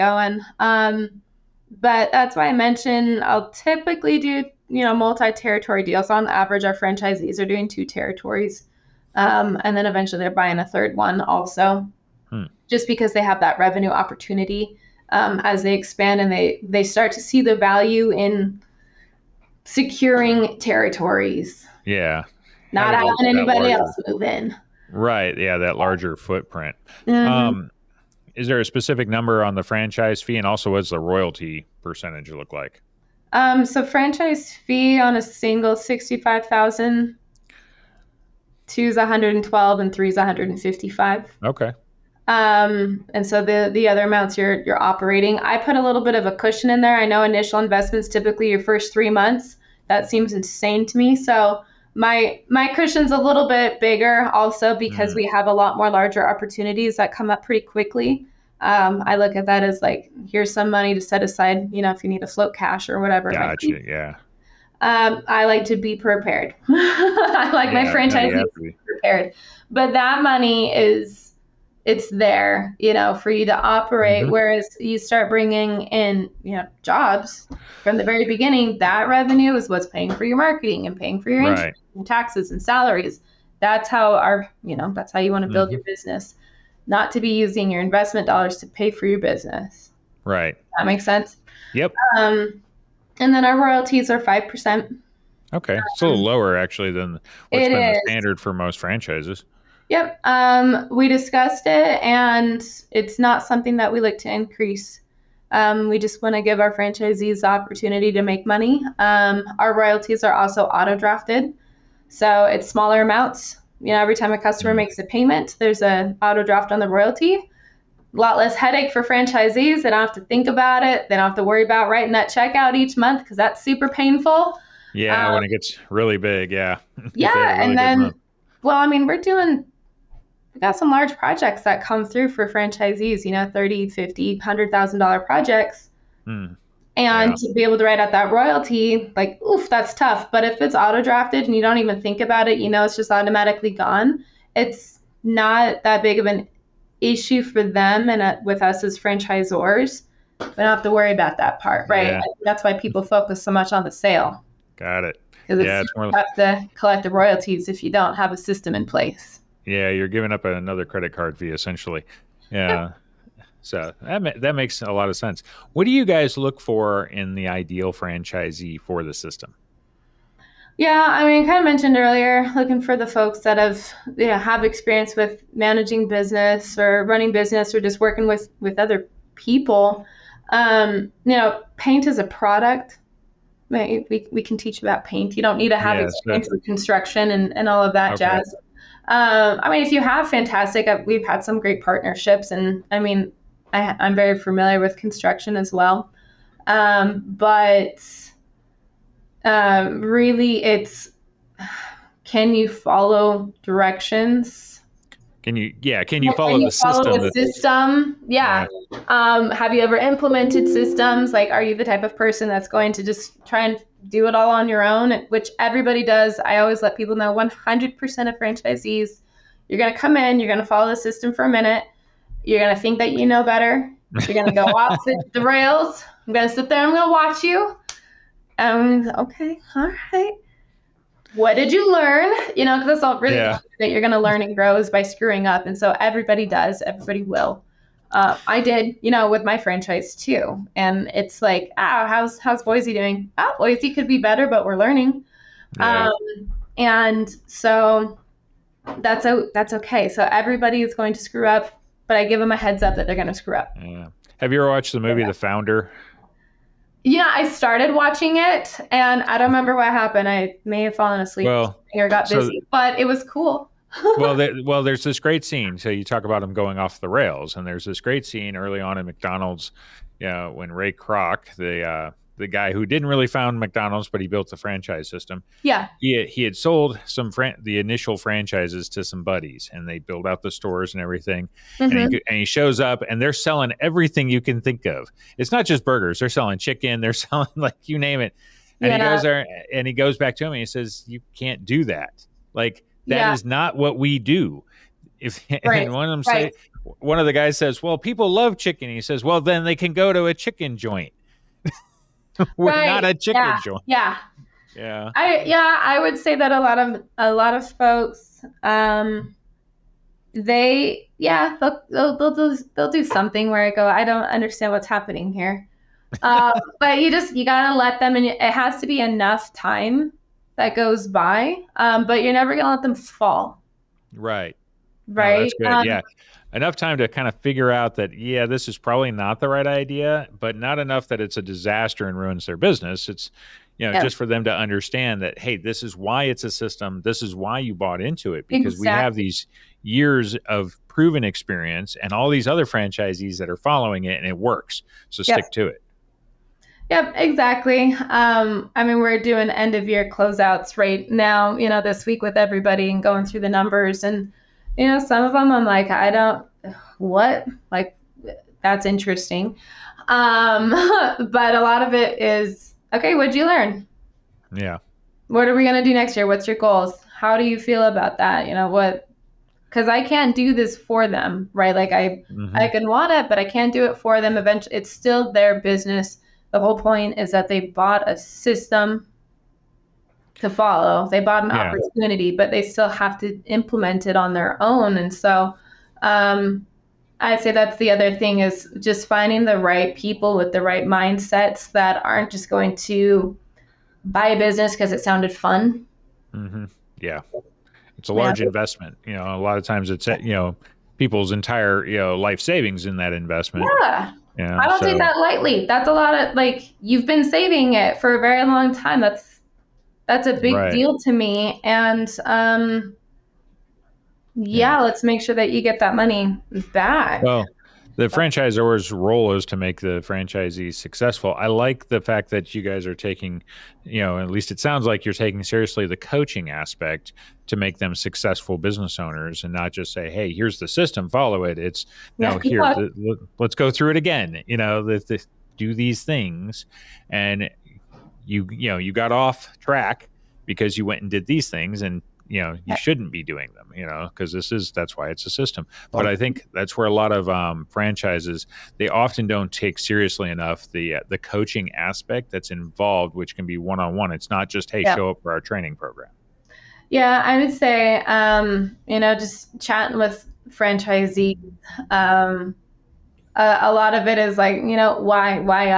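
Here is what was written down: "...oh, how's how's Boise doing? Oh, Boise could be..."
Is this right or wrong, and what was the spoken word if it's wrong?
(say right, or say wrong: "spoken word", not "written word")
right.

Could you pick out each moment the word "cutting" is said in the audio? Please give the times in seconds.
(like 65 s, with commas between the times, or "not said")
not said.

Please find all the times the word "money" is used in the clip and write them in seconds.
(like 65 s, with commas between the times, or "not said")
60 s, 70 s, 108 s, 415 s.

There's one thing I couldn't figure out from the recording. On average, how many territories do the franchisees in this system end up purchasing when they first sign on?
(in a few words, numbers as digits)
2.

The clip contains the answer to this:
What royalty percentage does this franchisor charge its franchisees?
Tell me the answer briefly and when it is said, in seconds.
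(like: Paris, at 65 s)
5%, at 94 s.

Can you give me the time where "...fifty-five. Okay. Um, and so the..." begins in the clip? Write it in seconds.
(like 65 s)
40 s.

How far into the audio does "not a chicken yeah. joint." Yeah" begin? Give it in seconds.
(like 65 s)
302 s.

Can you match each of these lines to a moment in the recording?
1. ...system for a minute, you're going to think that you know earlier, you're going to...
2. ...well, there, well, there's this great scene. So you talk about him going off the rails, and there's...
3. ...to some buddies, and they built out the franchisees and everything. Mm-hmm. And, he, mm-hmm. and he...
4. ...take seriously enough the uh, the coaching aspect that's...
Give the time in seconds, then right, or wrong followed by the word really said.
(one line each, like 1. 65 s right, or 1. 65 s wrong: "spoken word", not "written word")
1. 220 s wrong: "better", not "earlier"
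2. 264 s right
3. 278 s wrong: "stores", not "franchisees"
4. 449 s right.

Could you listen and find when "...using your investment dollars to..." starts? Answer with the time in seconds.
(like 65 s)
87 s.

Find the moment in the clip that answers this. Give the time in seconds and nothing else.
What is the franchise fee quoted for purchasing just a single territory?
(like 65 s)
35 s.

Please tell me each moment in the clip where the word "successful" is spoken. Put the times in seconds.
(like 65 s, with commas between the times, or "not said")
420 s, 427 s.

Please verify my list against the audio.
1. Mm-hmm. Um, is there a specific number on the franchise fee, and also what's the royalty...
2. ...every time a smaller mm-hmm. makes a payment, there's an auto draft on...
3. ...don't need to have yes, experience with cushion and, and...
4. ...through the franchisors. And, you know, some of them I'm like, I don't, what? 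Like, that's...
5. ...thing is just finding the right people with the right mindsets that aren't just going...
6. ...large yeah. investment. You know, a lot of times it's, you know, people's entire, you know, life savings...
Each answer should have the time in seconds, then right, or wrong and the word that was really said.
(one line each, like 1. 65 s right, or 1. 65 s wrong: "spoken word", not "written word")
1. 27 s right
2. 113 s wrong: "customer", not "smaller"
3. 185 s wrong: "construction", not "cushion"
4. 353 s wrong: "numbers", not "franchisors"
5. 388 s right
6. 398 s right.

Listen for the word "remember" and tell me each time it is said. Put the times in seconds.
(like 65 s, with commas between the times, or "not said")
259 s.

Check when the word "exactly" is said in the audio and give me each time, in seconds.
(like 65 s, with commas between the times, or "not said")
338 s, 347 s.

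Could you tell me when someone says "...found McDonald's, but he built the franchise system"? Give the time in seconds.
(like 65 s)
273 s.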